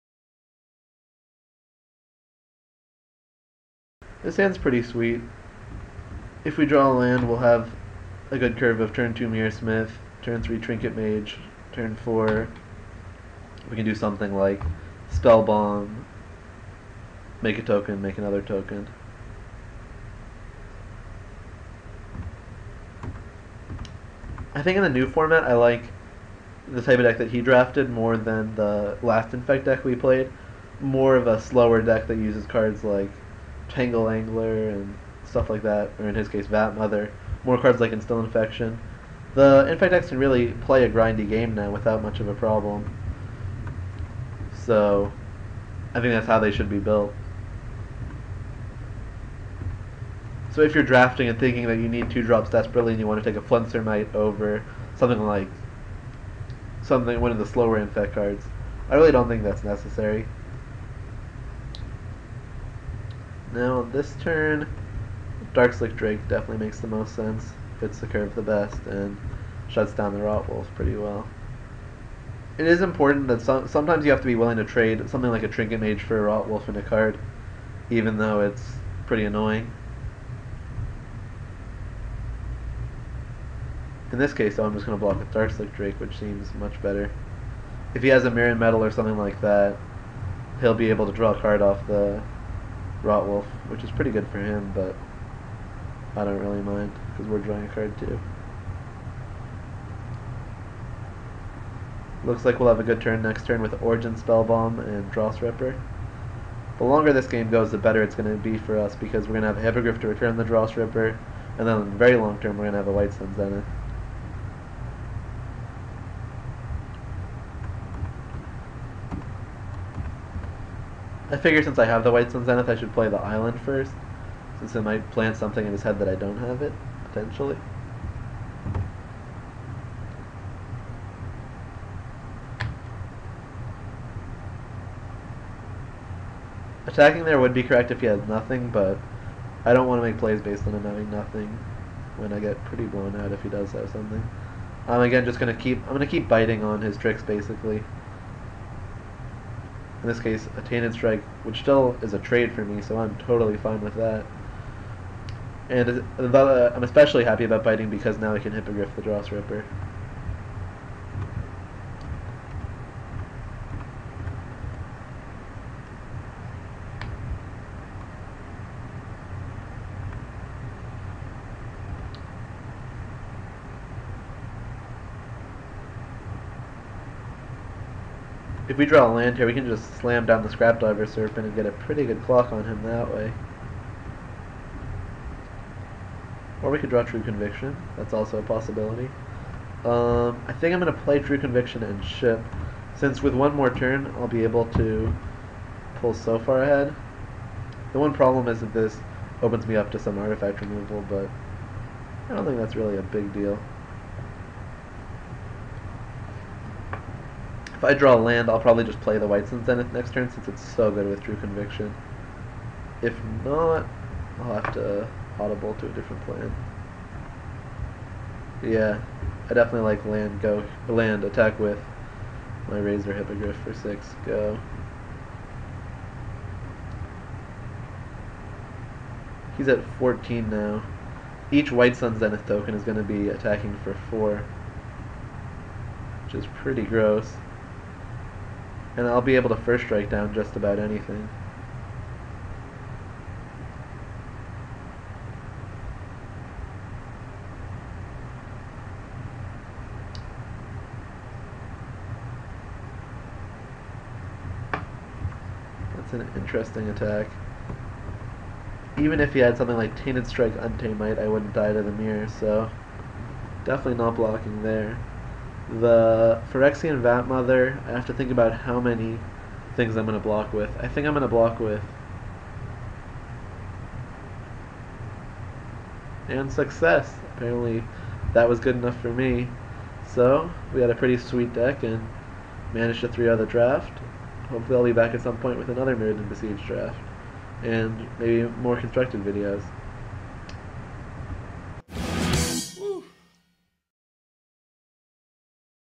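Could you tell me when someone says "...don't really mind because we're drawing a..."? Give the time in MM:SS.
01:36.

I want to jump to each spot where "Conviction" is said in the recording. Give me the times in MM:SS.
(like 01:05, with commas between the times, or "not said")
03:07, 03:11, 03:31.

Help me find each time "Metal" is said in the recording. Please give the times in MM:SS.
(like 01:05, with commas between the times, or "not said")
01:28.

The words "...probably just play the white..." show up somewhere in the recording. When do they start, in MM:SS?
03:28.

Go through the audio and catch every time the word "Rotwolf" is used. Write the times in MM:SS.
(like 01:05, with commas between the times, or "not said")
01:10, 01:16, 01:33.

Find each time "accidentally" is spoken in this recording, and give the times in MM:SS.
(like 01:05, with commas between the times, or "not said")
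not said.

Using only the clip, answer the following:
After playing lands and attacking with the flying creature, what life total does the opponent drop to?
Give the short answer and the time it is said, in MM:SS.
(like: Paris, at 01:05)
14, at 03:49.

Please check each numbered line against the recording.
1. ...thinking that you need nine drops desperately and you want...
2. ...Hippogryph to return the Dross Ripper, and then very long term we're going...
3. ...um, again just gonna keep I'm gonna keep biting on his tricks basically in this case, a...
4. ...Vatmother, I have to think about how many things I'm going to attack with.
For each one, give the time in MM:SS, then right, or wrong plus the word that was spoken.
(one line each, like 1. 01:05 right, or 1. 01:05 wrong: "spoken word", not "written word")
1. 00:51 wrong: "two", not "nine"
2. 01:49 right
3. 02:24 right
4. 04:27 wrong: "block", not "attack".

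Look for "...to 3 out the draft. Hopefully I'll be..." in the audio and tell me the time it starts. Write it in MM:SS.
04:43.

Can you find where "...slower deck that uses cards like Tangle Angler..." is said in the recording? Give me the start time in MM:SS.
00:31.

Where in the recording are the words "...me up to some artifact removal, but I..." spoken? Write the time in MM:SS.
03:19.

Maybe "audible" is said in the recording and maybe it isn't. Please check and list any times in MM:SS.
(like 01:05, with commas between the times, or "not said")
03:35.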